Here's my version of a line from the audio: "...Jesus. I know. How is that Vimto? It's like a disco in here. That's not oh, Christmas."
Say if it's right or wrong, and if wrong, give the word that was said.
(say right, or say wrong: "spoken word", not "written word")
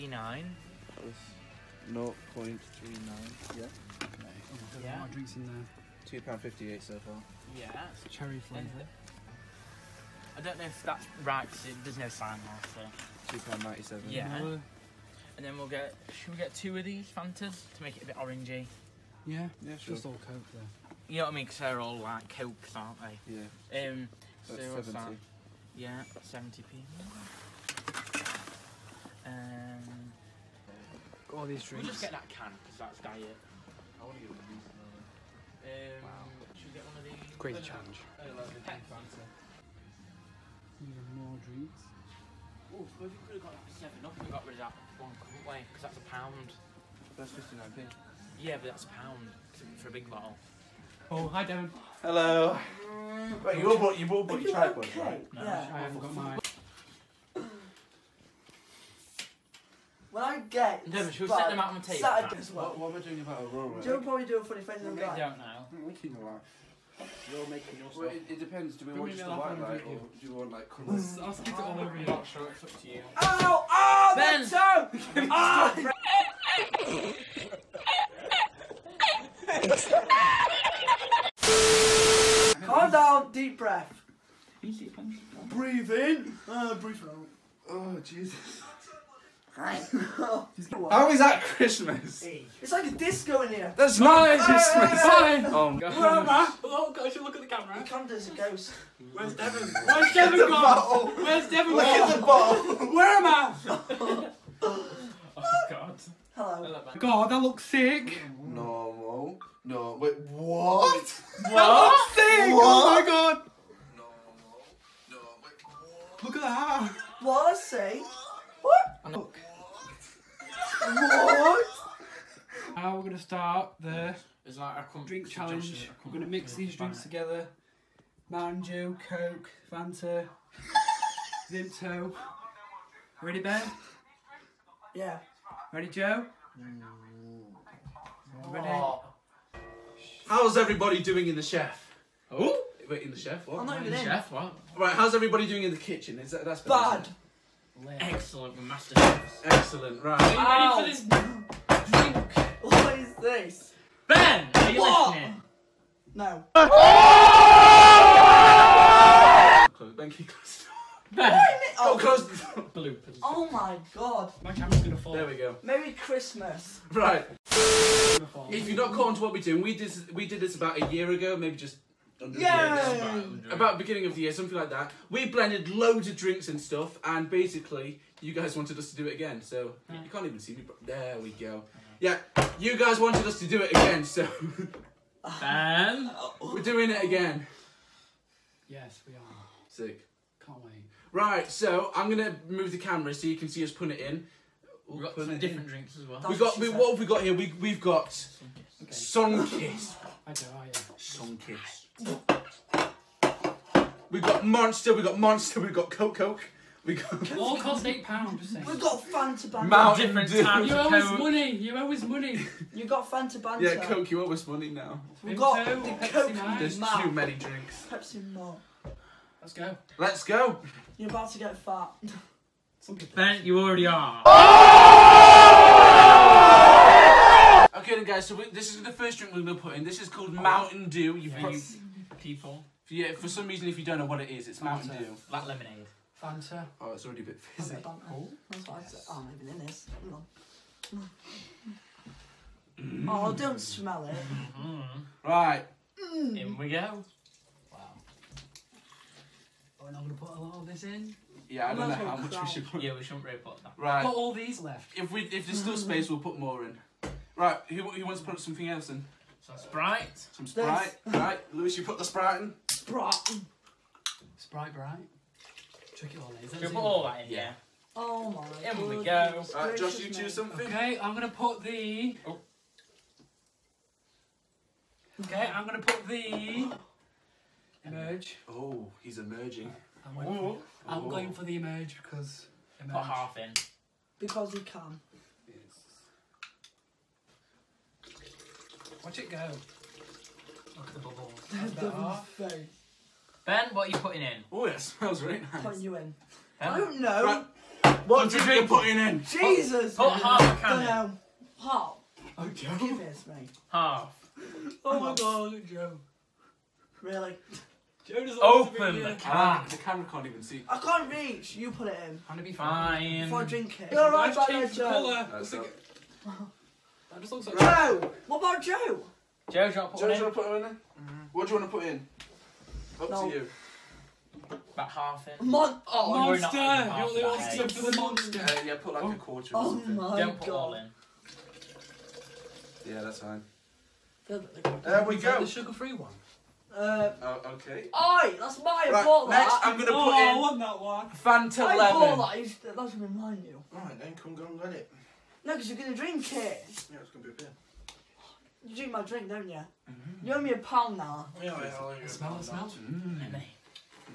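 wrong: "Christmas", not "Vimto".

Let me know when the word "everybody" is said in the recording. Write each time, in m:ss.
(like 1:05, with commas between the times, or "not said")
2:20, 2:25.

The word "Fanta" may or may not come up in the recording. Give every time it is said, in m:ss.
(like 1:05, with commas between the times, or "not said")
0:17, 2:09, 3:29, 3:33, 3:56, 5:41.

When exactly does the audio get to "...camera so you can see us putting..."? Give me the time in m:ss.
3:12.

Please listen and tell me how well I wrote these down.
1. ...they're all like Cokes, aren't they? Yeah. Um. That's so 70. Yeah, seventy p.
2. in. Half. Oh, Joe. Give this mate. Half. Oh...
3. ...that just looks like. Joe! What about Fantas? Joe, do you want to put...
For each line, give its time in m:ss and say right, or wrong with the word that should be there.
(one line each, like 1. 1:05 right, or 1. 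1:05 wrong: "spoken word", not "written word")
1. 0:21 right
2. 5:00 right
3. 5:17 wrong: "Joe", not "Fantas".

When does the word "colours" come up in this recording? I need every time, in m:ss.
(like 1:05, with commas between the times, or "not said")
1:10, 5:14.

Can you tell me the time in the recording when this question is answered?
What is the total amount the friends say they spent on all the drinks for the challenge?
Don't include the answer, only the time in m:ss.
3:27.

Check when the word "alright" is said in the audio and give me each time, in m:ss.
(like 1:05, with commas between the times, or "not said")
5:14, 5:43.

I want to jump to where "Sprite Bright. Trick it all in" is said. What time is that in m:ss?
4:24.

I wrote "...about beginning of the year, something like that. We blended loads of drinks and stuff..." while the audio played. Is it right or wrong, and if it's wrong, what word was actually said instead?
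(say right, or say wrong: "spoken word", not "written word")
right.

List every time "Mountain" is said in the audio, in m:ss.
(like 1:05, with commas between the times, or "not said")
3:29, 3:50, 3:54.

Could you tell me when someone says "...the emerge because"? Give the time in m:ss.
4:41.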